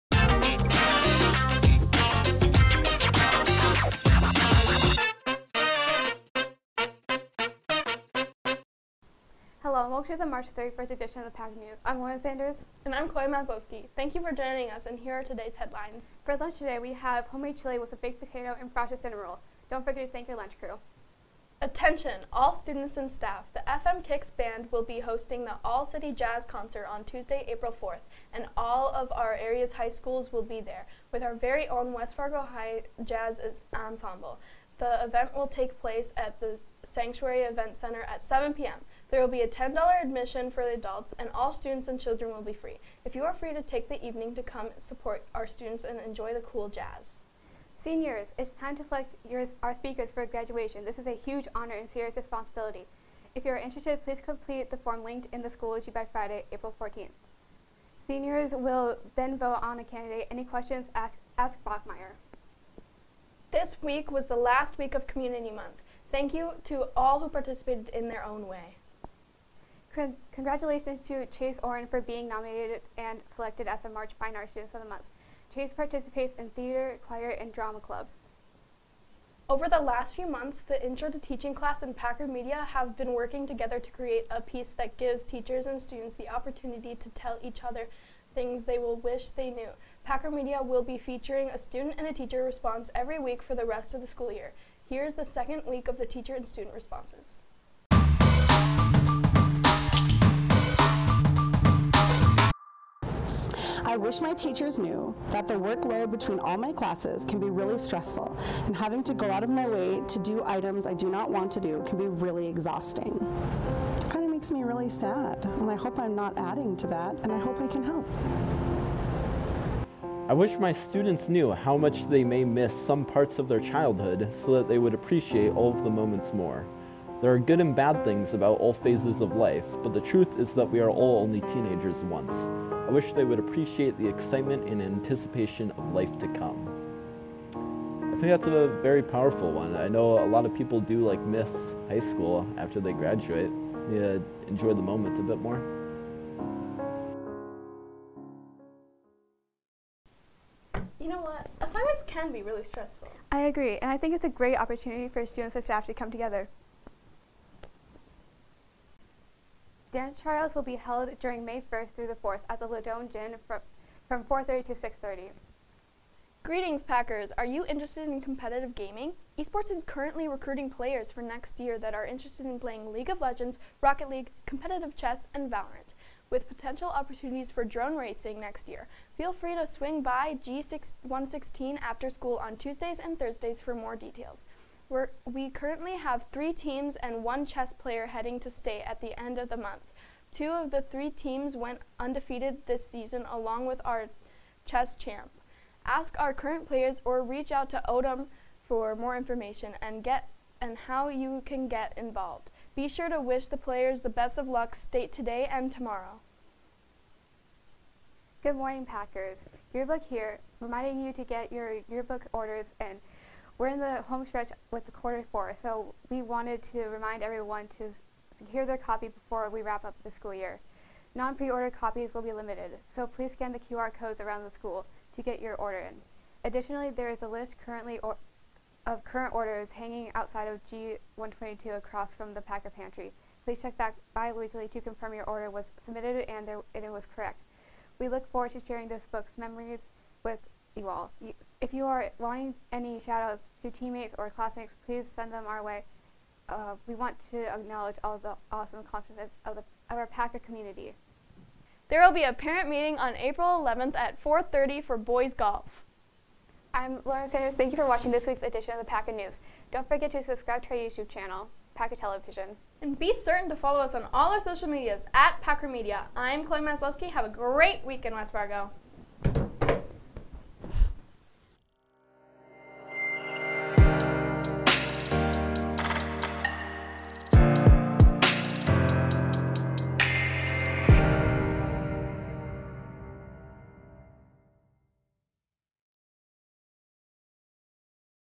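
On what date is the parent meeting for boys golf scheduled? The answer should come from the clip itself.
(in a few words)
April 11th.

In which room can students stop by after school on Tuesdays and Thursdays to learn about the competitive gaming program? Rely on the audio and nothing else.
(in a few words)
G116.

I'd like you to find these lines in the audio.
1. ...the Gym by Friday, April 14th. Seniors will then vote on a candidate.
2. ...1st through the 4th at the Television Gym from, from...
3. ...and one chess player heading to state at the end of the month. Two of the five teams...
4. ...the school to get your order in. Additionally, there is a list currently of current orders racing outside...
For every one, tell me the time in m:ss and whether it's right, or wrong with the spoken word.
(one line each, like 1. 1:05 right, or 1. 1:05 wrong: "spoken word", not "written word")
1. 0:55 wrong: "Schoology", not "Gym"
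2. 2:41 wrong: "Ladone", not "Television"
3. 3:06 wrong: "three", not "five"
4. 3:44 wrong: "hanging", not "racing".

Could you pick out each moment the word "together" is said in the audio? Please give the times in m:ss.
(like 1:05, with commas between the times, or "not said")
1:23, 2:36.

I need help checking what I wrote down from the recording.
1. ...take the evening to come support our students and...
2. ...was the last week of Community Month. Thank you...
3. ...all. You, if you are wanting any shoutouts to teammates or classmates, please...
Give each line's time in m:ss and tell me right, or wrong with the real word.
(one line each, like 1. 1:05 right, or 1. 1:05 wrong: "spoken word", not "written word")
1. 0:43 right
2. 1:04 right
3. 4:00 right.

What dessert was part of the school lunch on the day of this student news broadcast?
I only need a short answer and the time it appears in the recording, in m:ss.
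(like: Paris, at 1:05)
cinnamon roll, at 0:18.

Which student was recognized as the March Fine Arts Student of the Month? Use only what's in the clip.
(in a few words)
Chase Oren.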